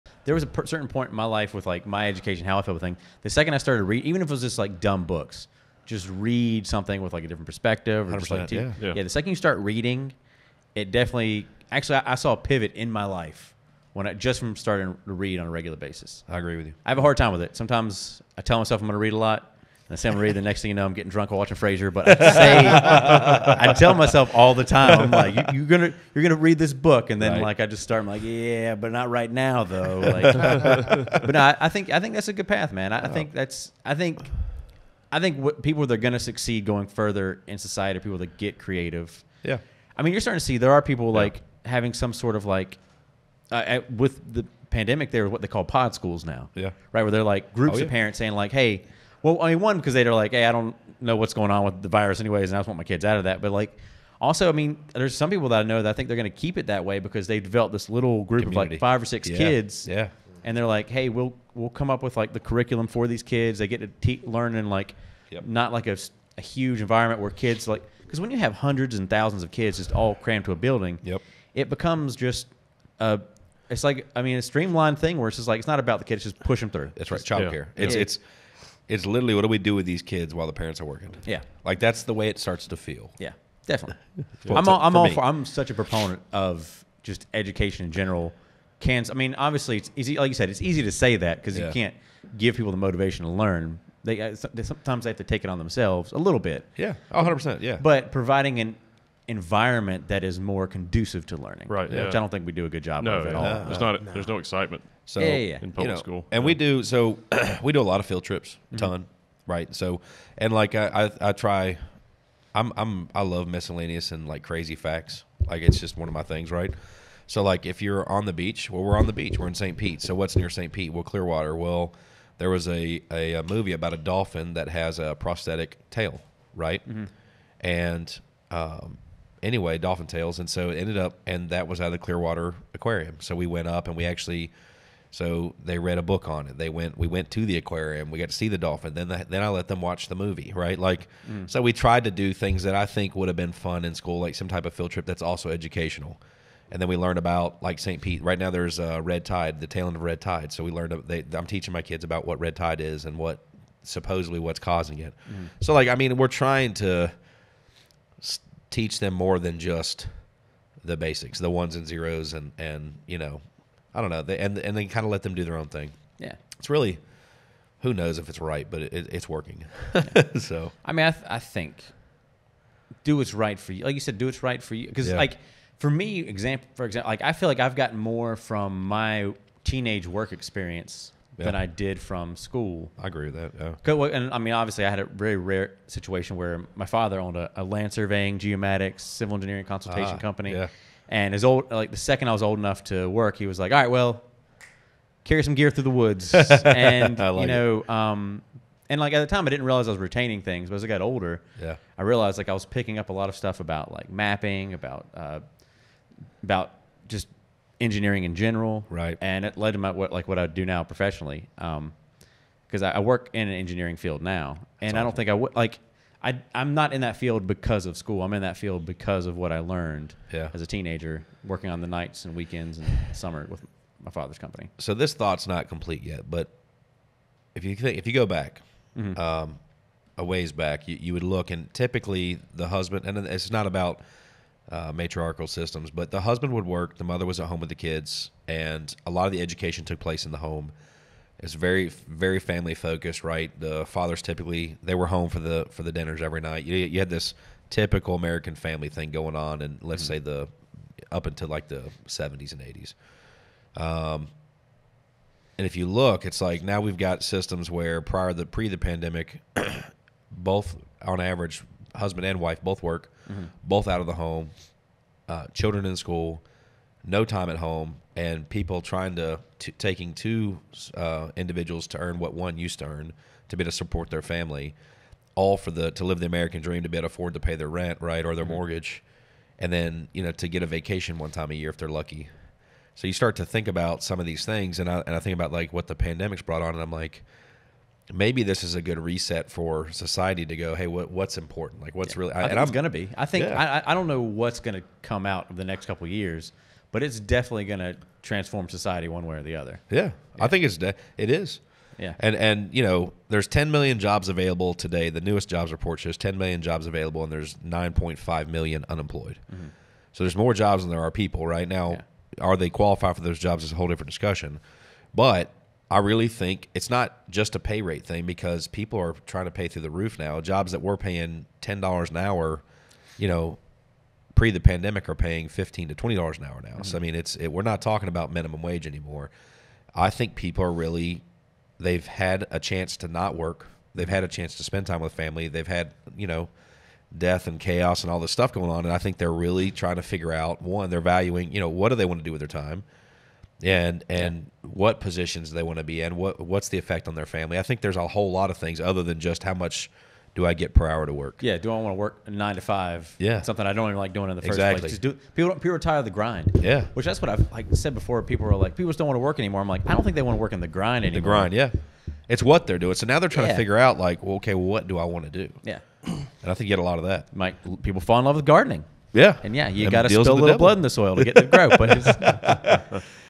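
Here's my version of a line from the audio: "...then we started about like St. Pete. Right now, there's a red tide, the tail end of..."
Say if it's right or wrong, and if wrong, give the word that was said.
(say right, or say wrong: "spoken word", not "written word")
wrong: "learned", not "started".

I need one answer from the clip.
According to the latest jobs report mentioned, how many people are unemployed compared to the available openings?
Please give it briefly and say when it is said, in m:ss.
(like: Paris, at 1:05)
9.5 million, at 5:07.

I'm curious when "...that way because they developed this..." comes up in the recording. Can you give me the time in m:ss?
0:56.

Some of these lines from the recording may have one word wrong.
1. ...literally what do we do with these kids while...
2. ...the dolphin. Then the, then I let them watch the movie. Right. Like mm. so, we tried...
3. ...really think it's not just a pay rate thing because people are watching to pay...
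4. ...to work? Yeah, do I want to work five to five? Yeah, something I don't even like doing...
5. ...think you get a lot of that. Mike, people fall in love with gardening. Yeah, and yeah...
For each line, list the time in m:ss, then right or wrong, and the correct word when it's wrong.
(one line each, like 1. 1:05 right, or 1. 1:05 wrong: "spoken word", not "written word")
1. 1:19 right
2. 2:18 right
3. 5:15 wrong: "trying", not "watching"
4. 5:51 wrong: "nine", not "five"
5. 6:06 right.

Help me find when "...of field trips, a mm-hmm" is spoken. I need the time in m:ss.
1:47.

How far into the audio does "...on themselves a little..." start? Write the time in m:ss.
1:35.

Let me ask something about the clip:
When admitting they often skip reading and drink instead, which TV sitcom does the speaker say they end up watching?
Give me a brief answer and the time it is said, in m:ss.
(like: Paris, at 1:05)
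Frasier, at 0:21.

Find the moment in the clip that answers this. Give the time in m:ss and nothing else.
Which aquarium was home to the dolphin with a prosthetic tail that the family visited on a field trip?
2:11.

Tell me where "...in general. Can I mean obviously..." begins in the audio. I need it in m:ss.
1:27.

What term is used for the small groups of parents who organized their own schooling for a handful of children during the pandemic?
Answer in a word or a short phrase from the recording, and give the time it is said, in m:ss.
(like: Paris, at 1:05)
pod schools, at 0:45.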